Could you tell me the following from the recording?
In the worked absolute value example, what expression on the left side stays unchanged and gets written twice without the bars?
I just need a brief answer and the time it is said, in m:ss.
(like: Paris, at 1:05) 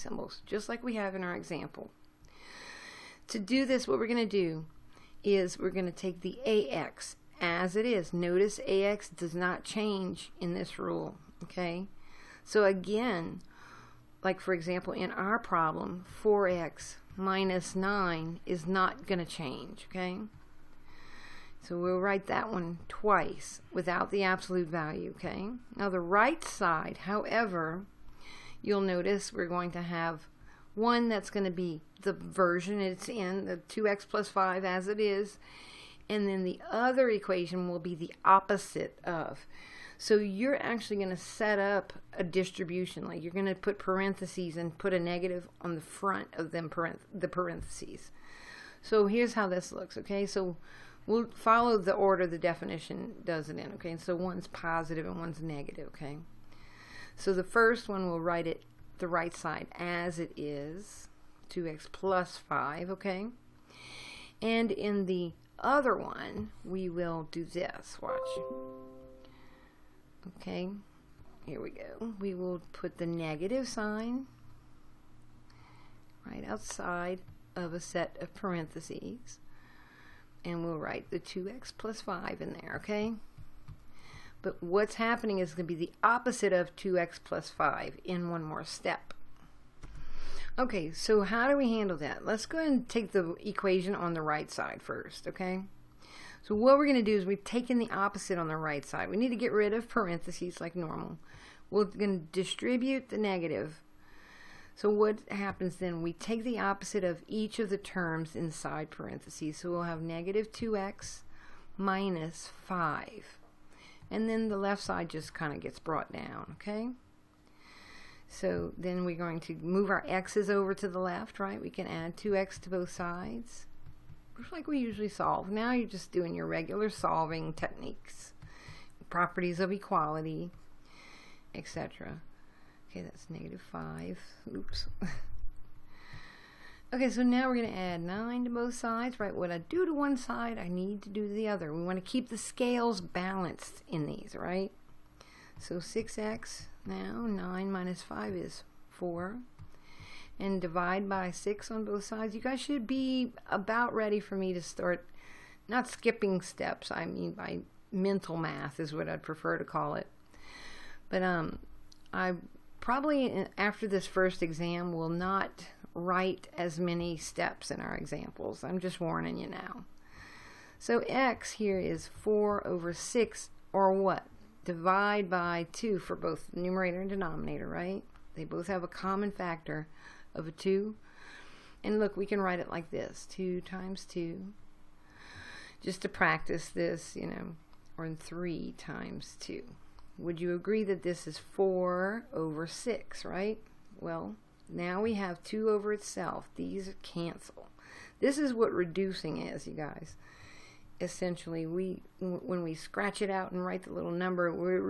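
4x - 9, at 0:16.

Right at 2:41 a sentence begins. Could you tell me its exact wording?
But um, I probably, uh, after this first exam, will not write as many steps in our examples.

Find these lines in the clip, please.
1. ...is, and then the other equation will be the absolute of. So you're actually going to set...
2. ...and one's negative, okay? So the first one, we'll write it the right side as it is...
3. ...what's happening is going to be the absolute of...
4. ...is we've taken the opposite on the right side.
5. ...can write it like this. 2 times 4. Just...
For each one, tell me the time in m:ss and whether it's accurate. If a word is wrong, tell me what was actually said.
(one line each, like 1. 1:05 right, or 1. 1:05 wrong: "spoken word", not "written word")
1. 0:34 wrong: "opposite", not "absolute"
2. 0:55 right
3. 1:24 wrong: "opposite", not "absolute"
4. 1:37 right
5. 3:02 wrong: "2", not "4".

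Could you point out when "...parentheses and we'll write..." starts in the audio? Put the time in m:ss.
1:18.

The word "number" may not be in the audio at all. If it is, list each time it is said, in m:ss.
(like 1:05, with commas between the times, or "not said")
3:24.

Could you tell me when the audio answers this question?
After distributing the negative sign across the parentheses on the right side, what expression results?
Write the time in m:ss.
1:50.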